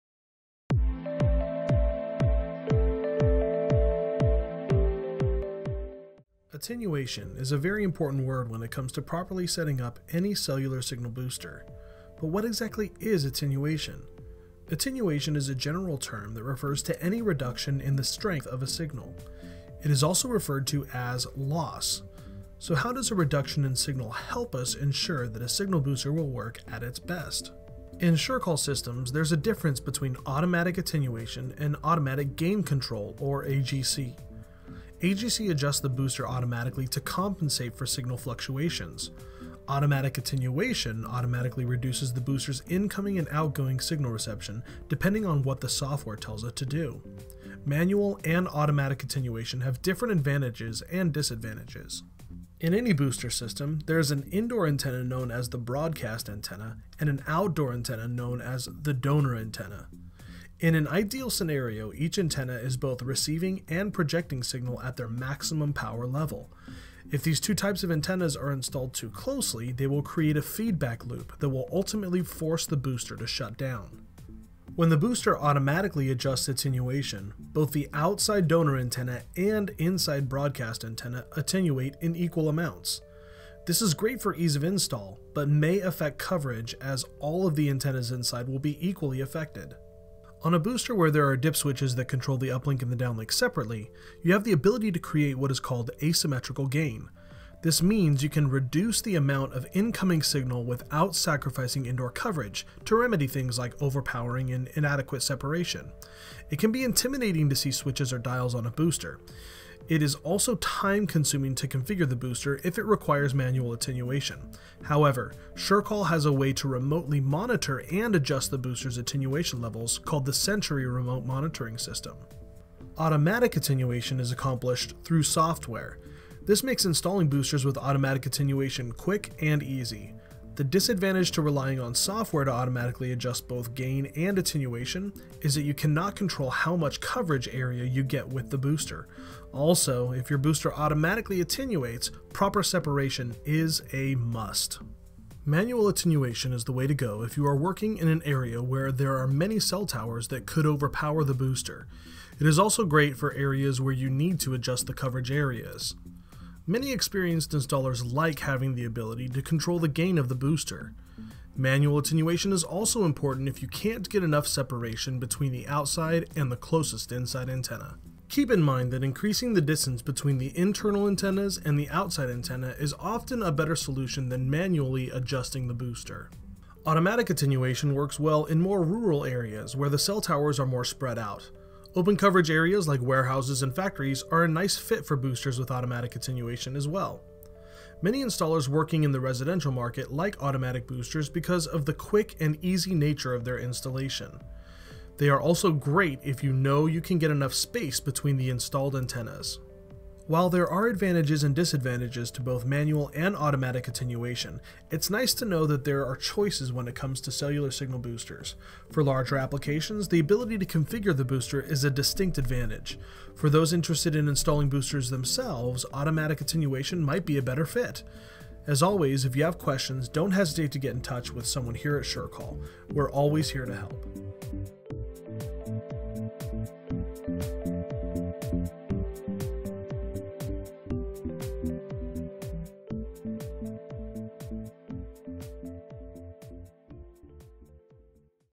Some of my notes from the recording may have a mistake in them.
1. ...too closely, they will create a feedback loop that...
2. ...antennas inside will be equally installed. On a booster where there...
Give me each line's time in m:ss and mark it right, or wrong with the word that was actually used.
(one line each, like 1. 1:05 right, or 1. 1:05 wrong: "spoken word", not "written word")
1. 1:08 right
2. 1:27 wrong: "affected", not "installed".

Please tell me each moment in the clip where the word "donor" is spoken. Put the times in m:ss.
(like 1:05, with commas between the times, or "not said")
0:58, 1:18.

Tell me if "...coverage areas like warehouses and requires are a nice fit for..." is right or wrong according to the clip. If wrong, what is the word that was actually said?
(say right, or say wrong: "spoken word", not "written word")
wrong: "factories", not "requires".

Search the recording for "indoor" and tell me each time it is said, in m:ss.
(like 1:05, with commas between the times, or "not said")
0:54, 1:41.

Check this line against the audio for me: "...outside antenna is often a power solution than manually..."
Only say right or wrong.
wrong.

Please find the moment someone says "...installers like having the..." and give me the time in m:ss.
2:37.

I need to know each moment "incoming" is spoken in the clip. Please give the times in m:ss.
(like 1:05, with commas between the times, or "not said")
0:42, 1:39.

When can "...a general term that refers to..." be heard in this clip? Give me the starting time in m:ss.
0:15.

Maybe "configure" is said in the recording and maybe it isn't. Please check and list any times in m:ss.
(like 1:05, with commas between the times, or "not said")
1:51, 3:30.